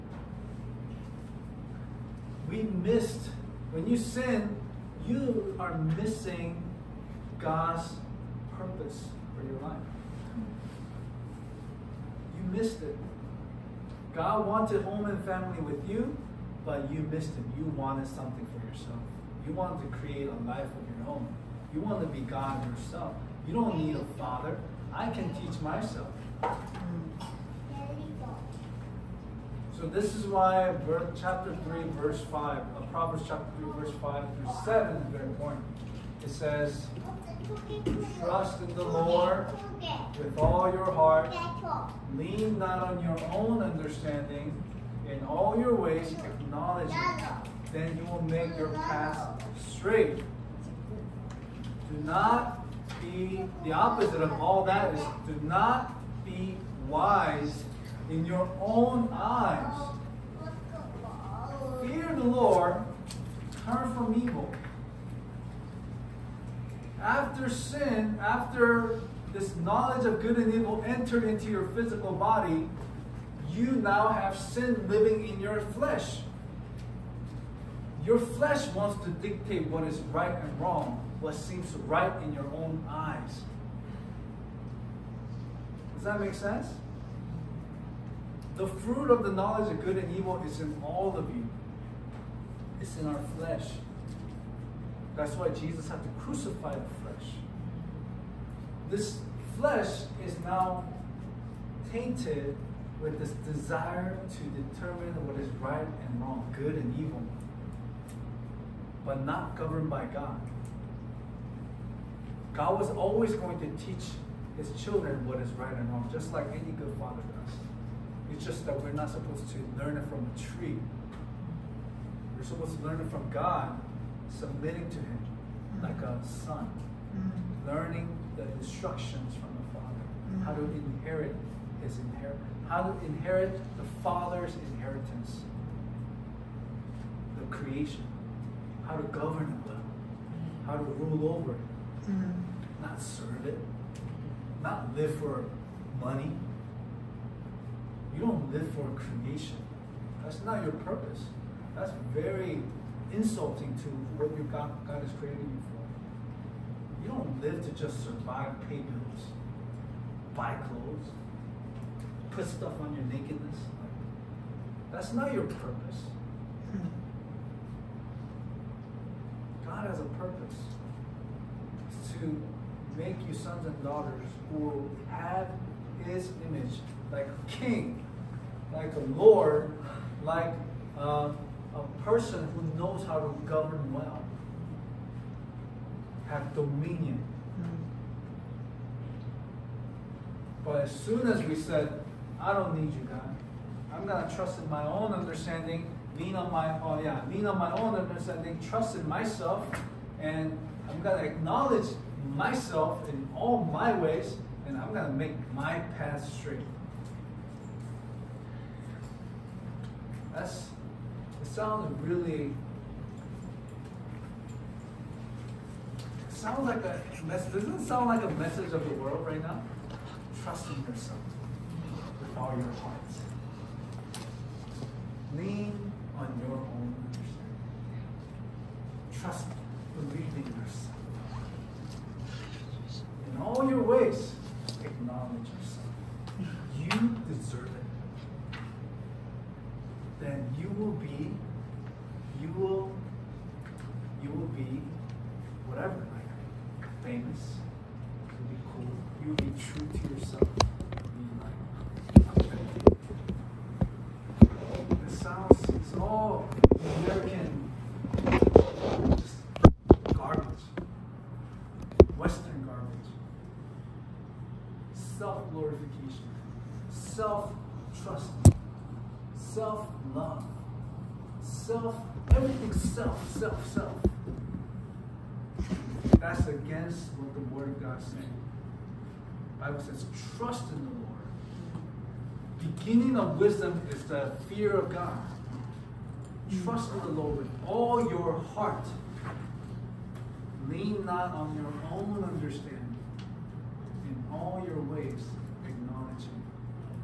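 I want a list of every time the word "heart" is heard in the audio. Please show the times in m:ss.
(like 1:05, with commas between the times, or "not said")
0:40, 3:42, 4:48.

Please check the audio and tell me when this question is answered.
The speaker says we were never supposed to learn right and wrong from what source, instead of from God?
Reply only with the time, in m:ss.
2:00.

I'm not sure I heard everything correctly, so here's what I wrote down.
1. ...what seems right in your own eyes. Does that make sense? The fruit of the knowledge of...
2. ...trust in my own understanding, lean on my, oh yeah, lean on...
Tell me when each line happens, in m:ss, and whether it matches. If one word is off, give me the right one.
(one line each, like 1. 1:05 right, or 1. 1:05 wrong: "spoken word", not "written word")
1. 1:21 right
2. 3:14 right.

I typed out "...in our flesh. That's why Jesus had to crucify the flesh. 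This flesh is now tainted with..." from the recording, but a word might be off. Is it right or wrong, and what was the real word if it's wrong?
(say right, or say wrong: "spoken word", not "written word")
right.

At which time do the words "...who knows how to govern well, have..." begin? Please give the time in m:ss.
3:02.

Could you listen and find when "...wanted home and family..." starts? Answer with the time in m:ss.
0:14.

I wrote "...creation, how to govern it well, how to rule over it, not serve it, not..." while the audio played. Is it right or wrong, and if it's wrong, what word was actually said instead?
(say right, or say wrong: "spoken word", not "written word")
right.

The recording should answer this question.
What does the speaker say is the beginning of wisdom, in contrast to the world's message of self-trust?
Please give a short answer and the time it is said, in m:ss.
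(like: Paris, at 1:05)
The fear of God, at 4:44.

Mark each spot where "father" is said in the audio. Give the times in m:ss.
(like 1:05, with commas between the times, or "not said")
0:24, 1:56, 2:09, 2:14.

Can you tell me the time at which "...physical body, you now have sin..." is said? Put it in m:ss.
1:11.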